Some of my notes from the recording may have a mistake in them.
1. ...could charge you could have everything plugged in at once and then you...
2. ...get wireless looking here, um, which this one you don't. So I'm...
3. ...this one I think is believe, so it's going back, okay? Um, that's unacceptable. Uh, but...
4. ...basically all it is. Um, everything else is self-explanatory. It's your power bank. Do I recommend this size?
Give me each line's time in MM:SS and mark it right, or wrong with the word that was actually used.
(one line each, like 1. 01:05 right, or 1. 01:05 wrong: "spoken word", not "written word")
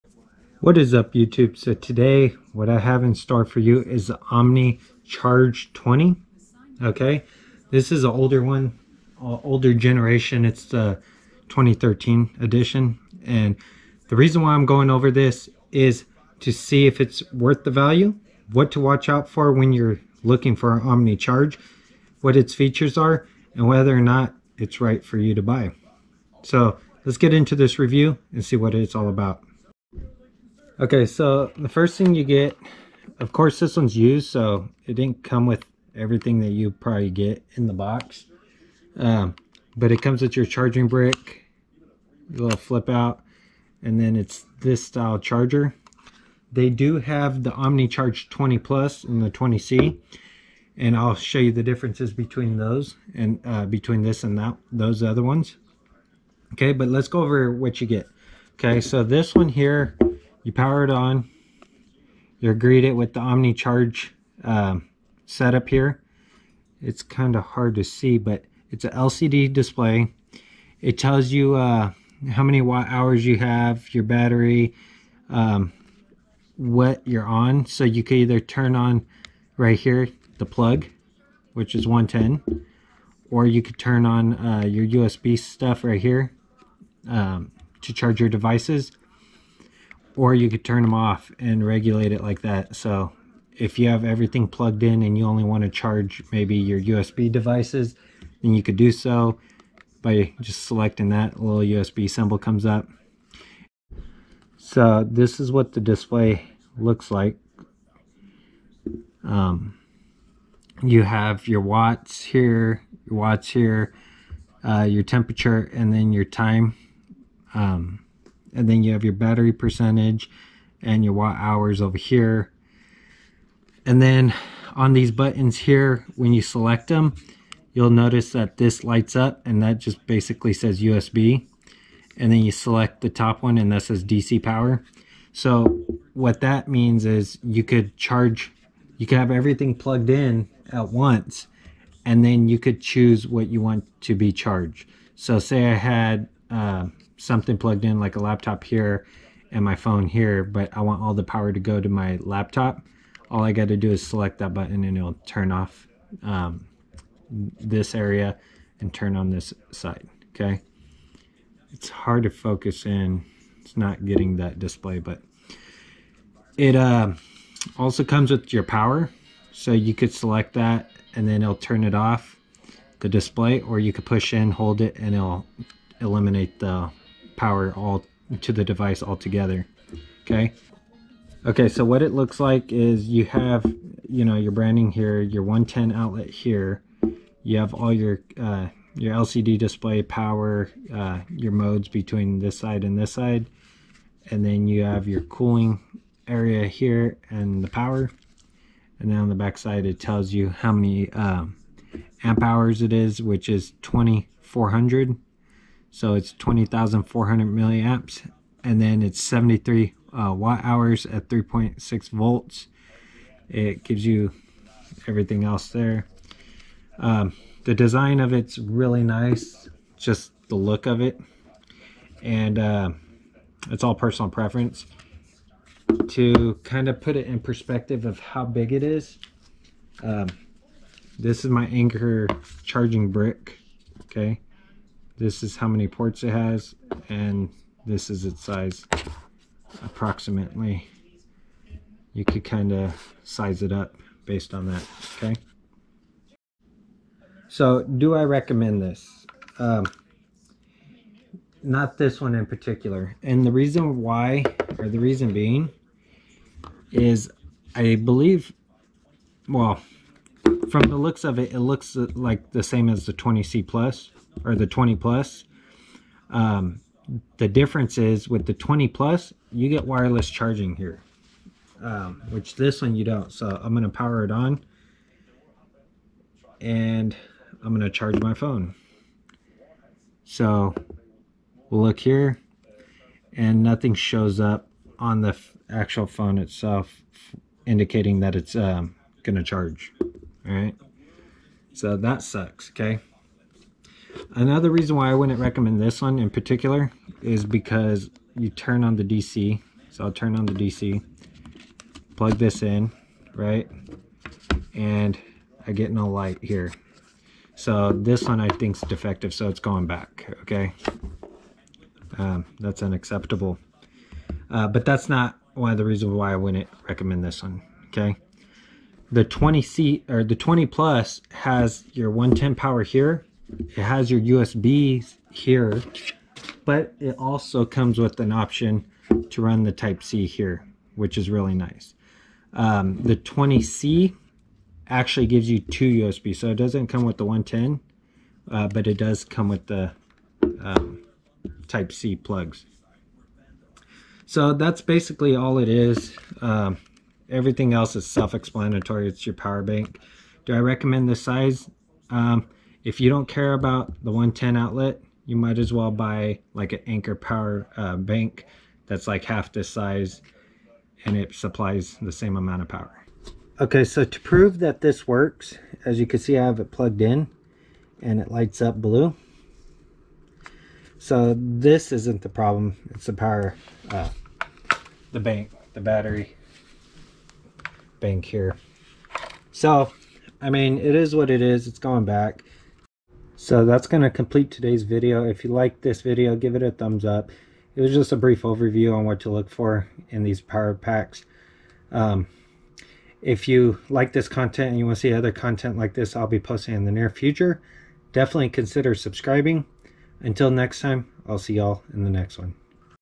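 1. 02:17 right
2. 04:29 wrong: "charging", not "looking"
3. 05:07 wrong: "defective", not "believe"
4. 05:44 right.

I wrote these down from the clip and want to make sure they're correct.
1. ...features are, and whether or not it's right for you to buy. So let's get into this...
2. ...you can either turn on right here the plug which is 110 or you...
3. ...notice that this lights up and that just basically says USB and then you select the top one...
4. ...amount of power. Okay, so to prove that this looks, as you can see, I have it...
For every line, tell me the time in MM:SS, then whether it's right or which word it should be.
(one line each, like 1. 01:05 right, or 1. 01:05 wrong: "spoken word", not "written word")
1. 00:22 right
2. 01:17 right
3. 02:07 right
4. 06:02 wrong: "works", not "looks".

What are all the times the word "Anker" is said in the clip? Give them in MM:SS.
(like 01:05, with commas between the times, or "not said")
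03:51, 05:56.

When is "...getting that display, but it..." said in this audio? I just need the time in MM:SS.
02:44.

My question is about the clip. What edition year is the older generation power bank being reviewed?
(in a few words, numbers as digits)
2013.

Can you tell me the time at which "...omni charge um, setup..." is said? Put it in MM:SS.
01:03.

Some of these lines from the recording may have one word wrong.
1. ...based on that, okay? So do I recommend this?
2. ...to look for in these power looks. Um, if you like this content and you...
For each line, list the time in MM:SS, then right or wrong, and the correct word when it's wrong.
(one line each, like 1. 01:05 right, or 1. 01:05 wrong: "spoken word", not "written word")
1. 04:04 right
2. 06:29 wrong: "packs", not "looks".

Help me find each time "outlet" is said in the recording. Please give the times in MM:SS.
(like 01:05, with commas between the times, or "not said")
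03:05, 05:54.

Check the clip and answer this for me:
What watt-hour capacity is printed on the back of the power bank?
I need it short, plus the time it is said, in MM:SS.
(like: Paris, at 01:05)
73 watt hours, at 03:29.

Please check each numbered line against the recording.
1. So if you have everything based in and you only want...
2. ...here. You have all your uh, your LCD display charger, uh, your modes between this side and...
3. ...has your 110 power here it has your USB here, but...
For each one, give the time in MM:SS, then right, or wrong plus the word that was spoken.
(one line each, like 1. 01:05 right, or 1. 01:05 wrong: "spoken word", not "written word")
1. 01:32 wrong: "plugged", not "based"
2. 03:06 wrong: "power", not "charger"
3. 05:21 right.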